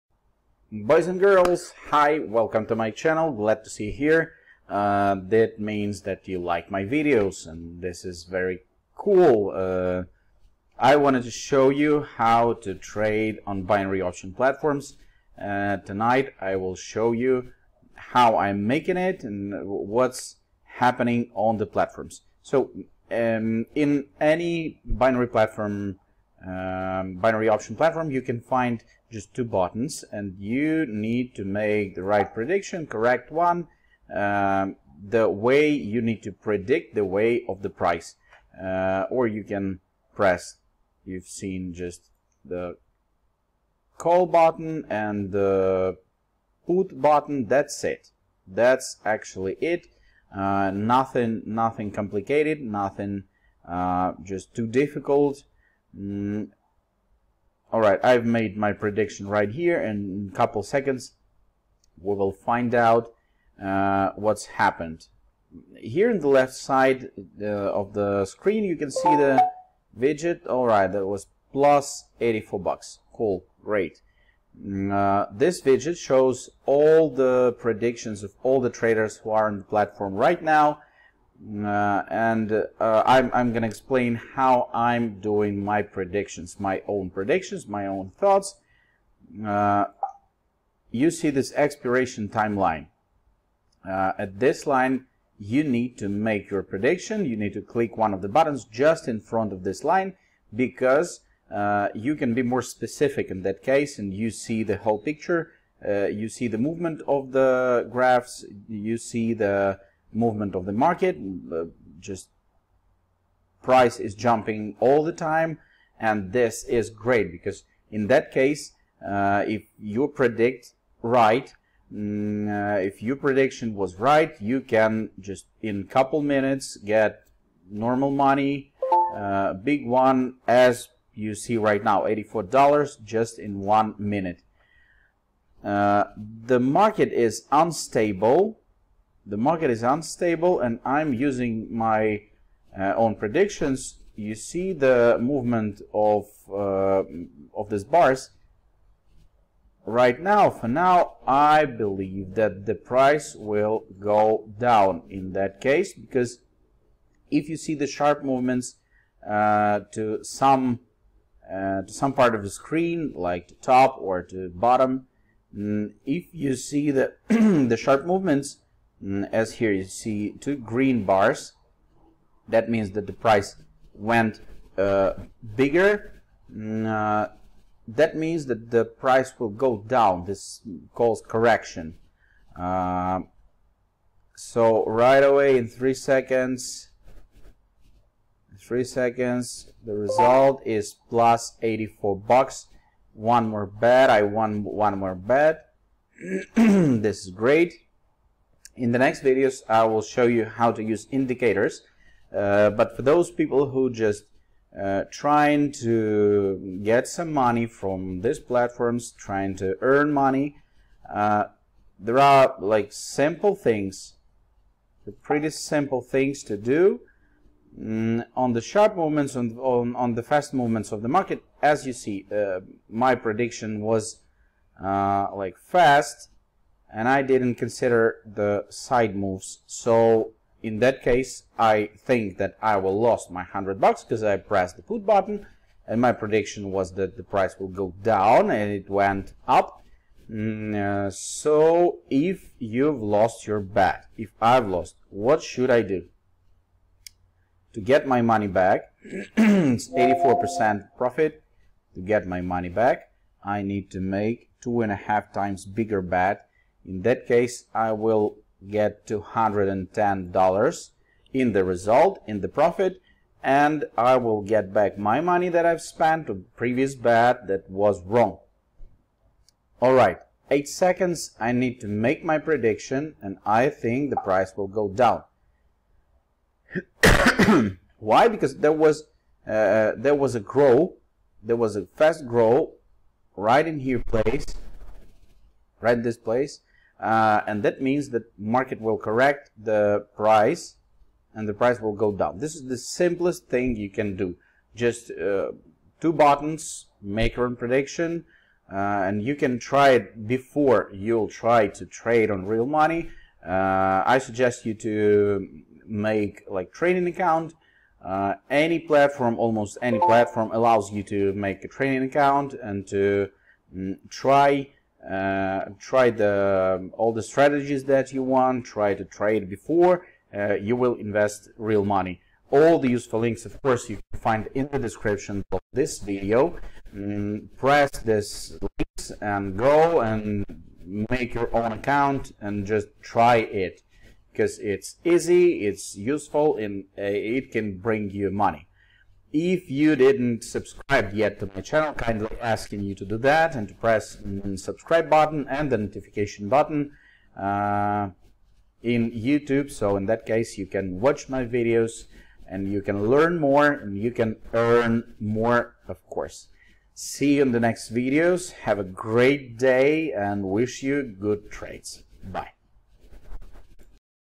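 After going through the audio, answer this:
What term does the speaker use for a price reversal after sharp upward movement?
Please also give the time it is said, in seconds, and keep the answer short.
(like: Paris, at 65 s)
correction, at 181 s.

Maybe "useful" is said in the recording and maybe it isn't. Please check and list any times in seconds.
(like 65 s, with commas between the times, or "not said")
322 s, 335 s.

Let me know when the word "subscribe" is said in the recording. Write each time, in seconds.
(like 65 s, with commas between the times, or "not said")
340 s, 344 s.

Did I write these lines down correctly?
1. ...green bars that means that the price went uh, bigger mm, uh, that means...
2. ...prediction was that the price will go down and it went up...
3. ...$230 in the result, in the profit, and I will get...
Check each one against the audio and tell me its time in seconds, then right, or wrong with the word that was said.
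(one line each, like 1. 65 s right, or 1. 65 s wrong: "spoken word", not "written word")
1. 170 s right
2. 236 s right
3. 259 s wrong: "210", not "230".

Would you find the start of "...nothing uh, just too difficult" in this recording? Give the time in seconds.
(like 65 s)
52 s.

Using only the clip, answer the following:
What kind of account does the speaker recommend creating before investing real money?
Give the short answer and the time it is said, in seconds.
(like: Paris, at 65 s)
training account, at 311 s.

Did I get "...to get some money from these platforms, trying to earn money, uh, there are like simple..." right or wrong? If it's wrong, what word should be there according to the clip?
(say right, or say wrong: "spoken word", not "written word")
right.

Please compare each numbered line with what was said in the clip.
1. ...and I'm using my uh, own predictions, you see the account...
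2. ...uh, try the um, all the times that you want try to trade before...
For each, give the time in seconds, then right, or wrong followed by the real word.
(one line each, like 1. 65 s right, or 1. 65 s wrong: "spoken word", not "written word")
1. 140 s wrong: "movement", not "account"
2. 315 s wrong: "strategies", not "times".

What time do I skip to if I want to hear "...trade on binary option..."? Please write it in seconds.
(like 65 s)
12 s.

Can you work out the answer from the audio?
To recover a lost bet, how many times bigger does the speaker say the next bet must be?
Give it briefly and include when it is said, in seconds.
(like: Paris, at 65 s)
2.5 times, at 254 s.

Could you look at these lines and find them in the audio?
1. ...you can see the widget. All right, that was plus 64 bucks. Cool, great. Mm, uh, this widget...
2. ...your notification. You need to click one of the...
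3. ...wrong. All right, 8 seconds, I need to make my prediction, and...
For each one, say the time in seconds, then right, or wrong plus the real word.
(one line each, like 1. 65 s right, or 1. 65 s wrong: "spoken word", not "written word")
1. 68 s wrong: "84", not "64"
2. 96 s wrong: "prediction", not "notification"
3. 268 s right.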